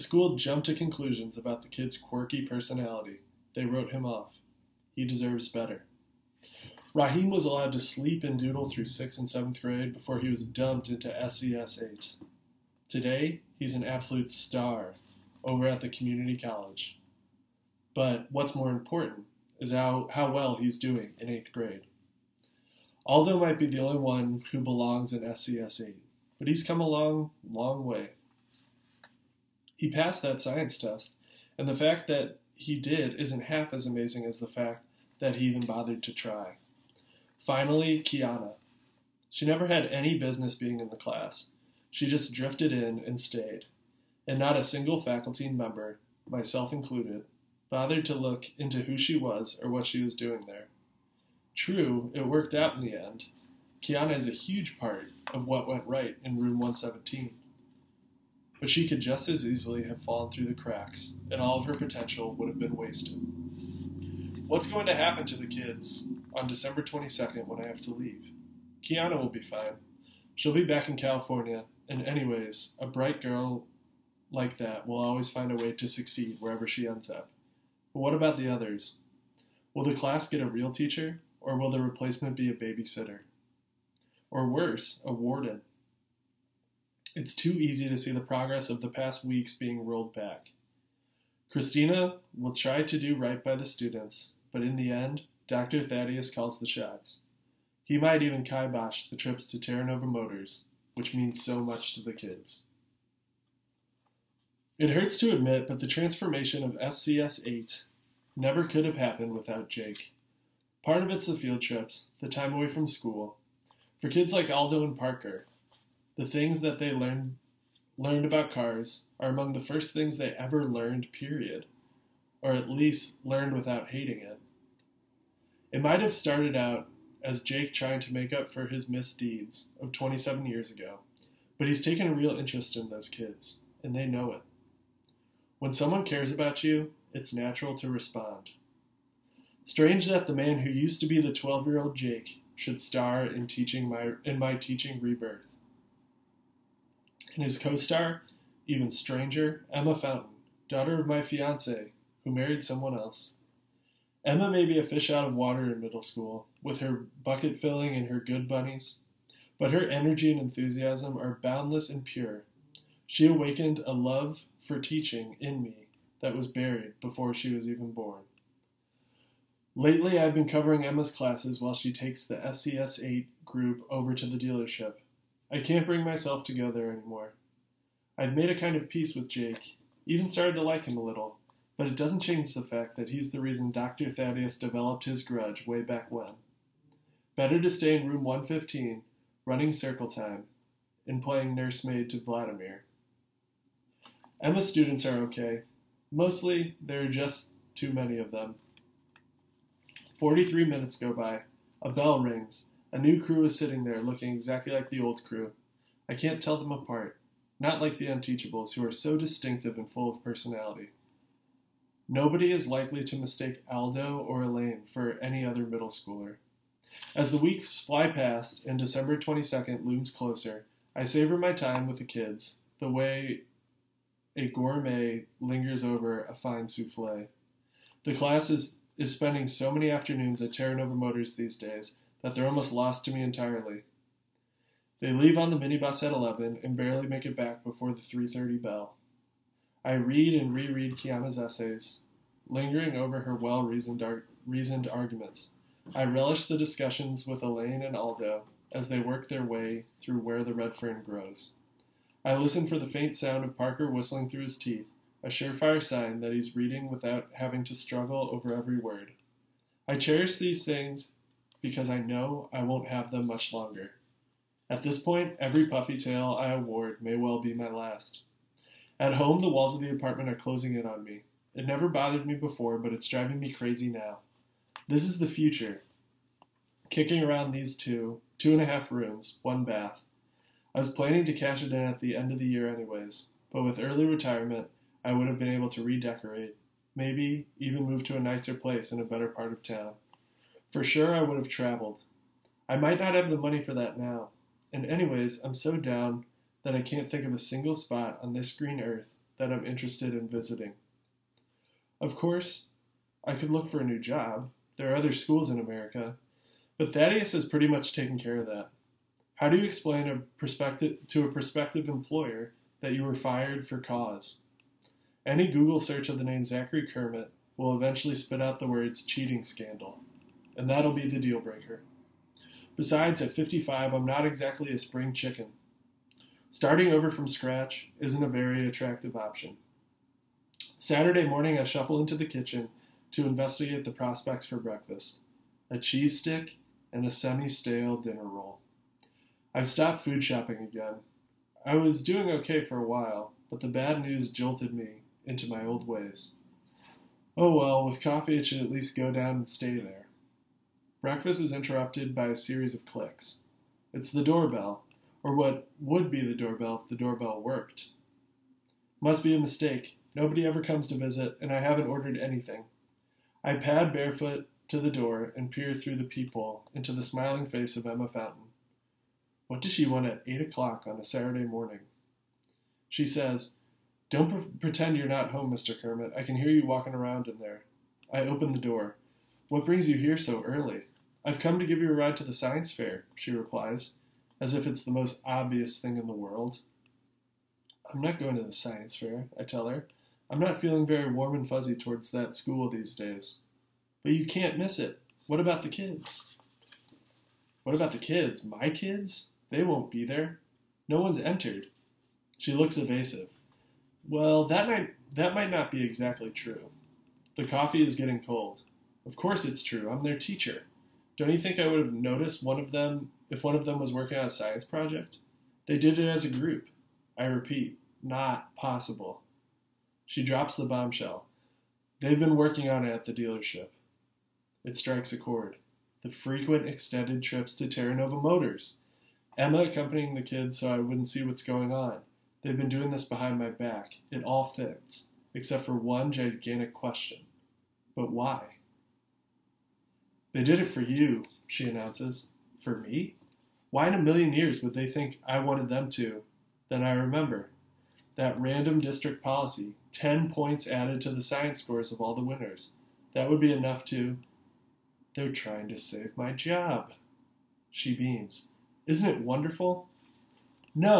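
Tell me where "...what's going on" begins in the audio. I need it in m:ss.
7:11.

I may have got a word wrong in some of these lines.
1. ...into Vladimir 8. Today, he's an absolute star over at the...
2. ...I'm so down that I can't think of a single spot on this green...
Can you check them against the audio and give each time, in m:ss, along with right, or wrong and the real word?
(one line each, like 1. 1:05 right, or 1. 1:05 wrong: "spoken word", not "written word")
1. 0:10 wrong: "SCS", not "Vladimir"
2. 4:55 right.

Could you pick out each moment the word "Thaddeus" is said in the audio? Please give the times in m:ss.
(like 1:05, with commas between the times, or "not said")
1:35, 3:04, 5:06.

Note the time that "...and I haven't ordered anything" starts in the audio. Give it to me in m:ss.
6:01.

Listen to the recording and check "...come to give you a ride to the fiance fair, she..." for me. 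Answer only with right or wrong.
wrong.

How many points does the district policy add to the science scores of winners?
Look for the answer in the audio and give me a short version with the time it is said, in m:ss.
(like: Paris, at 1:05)
10, at 7:29.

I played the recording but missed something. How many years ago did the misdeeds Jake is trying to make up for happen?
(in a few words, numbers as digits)
27.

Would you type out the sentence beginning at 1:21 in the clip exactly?
Or will the replacement be a babysitter?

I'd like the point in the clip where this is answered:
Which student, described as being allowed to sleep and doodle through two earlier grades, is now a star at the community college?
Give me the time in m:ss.
0:06.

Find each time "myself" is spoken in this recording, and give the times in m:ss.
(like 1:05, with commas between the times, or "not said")
0:46, 2:56.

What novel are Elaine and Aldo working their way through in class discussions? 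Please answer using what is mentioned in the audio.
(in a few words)
Where the Red Fern Grows.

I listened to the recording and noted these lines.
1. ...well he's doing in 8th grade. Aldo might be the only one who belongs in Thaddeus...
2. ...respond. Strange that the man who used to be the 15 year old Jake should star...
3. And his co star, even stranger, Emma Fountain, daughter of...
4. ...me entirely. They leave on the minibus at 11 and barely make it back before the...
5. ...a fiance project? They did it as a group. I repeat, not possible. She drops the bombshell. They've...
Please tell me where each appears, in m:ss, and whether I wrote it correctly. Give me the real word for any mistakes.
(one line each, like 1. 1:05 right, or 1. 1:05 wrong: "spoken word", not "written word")
1. 0:20 wrong: "SCS", not "Thaddeus"
2. 2:17 wrong: "12", not "15"
3. 2:27 right
4. 3:53 right
5. 6:54 wrong: "science", not "fiance".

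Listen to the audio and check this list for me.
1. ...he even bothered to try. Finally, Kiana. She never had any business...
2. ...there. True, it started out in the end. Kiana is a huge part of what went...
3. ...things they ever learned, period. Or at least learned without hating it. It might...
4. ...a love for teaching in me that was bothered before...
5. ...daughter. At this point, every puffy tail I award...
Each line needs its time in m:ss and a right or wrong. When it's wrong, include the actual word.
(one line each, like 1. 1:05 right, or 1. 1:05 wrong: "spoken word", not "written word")
1. 0:35 right
2. 0:50 wrong: "worked", not "started"
3. 1:59 right
4. 2:43 wrong: "buried", not "bothered"
5. 4:23 wrong: "longer", not "daughter".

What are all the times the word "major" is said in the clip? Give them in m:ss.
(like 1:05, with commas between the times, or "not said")
not said.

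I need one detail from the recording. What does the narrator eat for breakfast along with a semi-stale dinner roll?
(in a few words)
A cheese stick.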